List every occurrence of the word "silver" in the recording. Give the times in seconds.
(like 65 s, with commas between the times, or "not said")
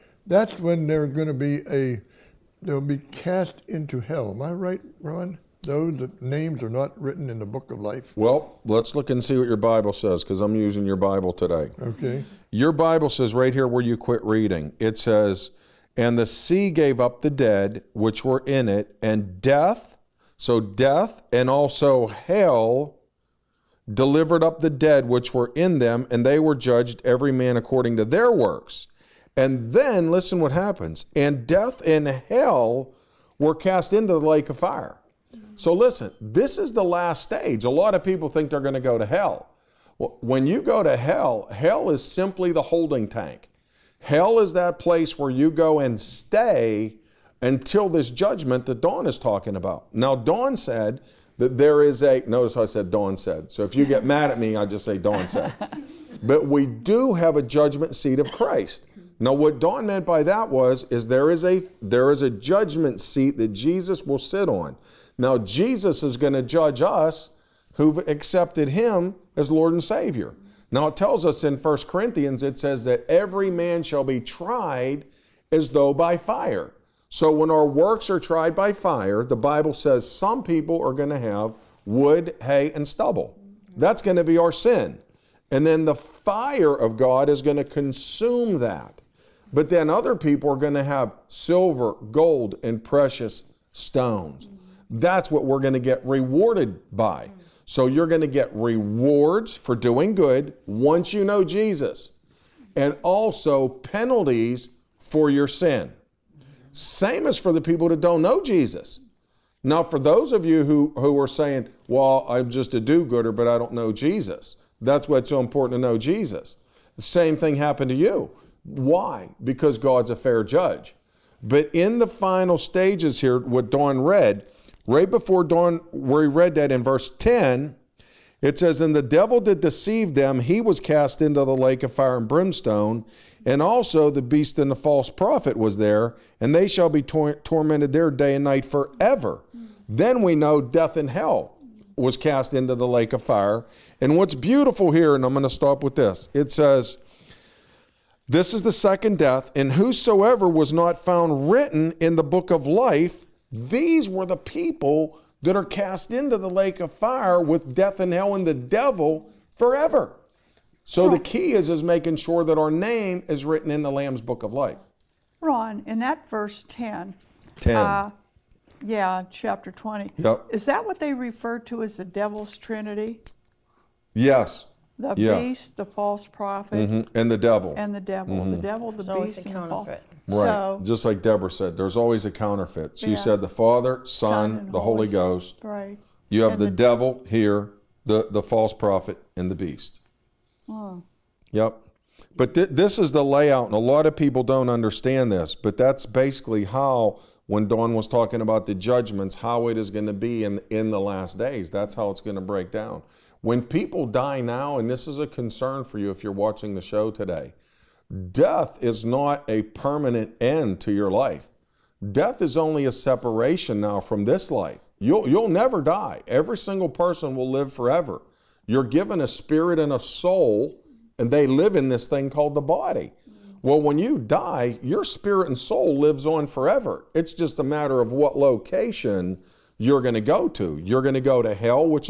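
91 s.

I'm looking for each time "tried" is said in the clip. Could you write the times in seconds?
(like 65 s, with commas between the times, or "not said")
74 s, 78 s.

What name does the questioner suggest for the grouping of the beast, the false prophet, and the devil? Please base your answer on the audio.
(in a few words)
The devil's trinity.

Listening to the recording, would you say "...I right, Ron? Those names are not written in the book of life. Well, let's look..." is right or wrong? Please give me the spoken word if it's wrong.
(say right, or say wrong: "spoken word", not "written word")
right.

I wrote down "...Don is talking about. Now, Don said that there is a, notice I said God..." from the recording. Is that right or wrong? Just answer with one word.
wrong.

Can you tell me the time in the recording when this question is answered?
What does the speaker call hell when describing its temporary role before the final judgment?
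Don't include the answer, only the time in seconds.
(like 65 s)
42 s.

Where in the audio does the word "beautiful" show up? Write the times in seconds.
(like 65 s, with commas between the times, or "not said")
144 s.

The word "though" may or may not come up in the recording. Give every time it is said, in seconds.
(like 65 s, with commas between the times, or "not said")
75 s.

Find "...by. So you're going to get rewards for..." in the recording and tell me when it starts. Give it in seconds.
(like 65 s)
96 s.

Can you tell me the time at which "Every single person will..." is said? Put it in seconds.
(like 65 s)
216 s.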